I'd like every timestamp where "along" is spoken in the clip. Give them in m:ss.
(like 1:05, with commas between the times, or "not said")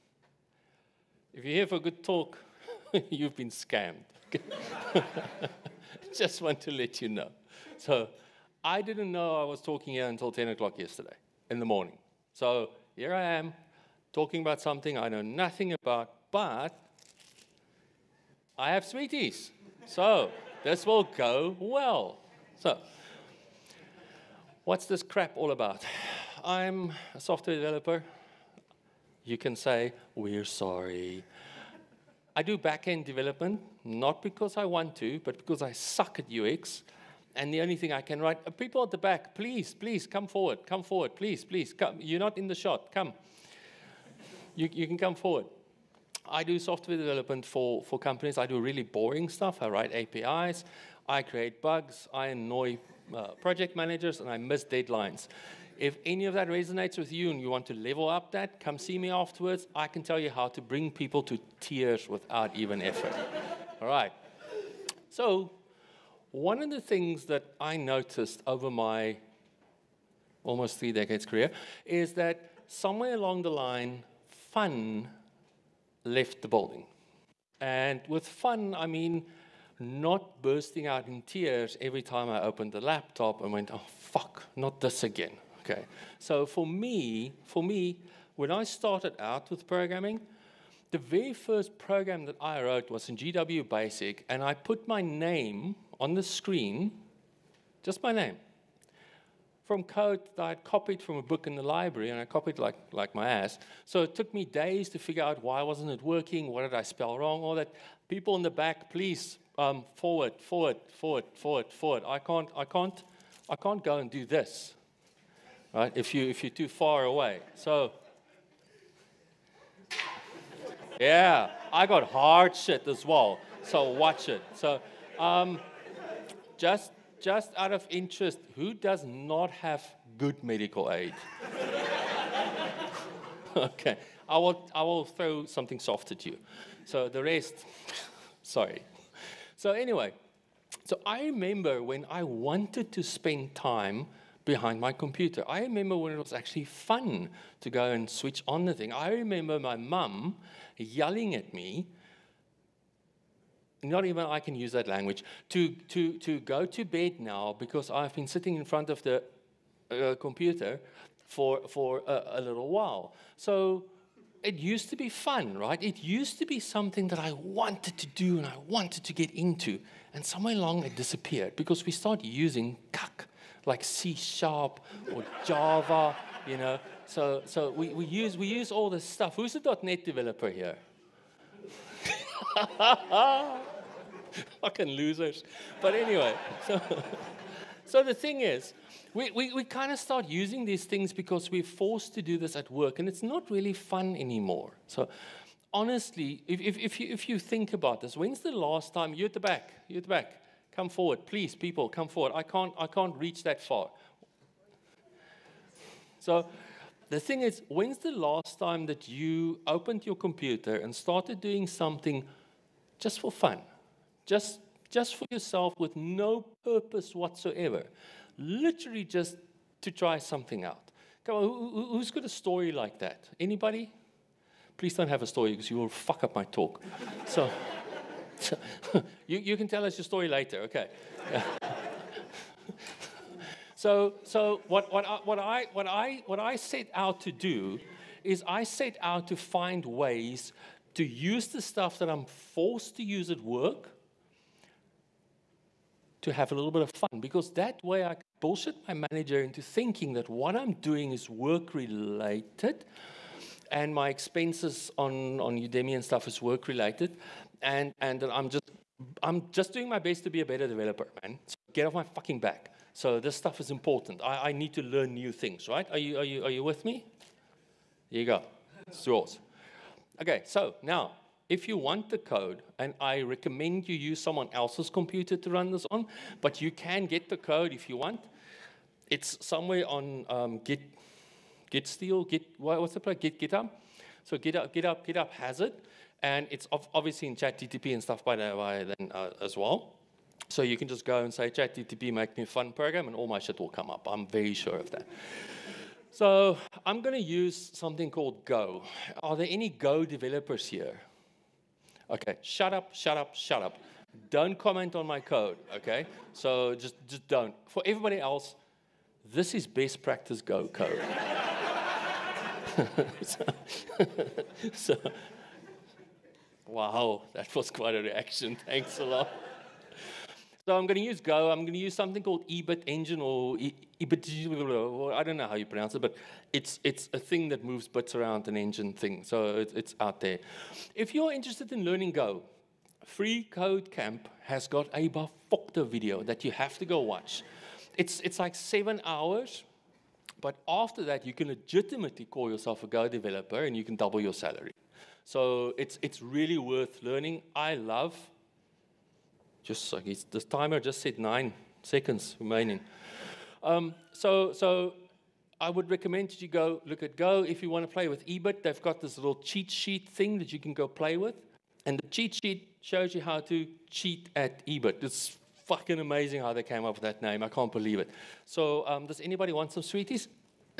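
1:13, 2:50.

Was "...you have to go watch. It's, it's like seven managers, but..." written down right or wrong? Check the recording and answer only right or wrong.
wrong.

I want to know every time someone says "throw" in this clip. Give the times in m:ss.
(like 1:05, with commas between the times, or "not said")
2:15.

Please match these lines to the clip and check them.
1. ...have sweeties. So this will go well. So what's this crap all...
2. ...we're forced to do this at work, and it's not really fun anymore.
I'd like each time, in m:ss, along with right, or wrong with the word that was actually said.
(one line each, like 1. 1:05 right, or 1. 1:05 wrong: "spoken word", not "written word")
1. 0:18 right
2. 3:11 right.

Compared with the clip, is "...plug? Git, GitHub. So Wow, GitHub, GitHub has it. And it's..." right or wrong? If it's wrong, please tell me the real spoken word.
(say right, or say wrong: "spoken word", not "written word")
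wrong: "GitHub", not "Wow".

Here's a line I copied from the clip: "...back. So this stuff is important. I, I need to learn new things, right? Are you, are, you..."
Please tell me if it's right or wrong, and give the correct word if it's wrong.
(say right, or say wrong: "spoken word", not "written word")
right.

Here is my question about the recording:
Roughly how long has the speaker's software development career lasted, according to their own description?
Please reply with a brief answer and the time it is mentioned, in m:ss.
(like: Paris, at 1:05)
almost three decades, at 1:10.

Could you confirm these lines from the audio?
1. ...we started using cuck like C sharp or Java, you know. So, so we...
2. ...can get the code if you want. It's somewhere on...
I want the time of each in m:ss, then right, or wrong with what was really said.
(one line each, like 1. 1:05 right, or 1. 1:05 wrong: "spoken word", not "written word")
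1. 2:51 right
2. 4:36 right.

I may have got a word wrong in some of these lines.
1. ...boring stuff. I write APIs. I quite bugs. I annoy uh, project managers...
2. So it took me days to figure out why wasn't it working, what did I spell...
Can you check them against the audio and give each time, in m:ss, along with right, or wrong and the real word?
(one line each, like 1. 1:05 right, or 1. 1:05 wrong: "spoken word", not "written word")
1. 0:48 wrong: "create", not "quite"
2. 1:43 right.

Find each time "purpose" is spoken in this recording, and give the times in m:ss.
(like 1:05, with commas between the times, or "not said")
3:36.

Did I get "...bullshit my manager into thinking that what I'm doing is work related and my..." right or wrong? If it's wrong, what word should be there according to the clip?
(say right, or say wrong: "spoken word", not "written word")
right.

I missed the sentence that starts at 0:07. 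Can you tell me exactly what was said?
So I didn't know I was talking here until 10 o'clock yesterday in the morning.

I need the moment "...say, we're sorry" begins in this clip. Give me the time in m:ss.
0:29.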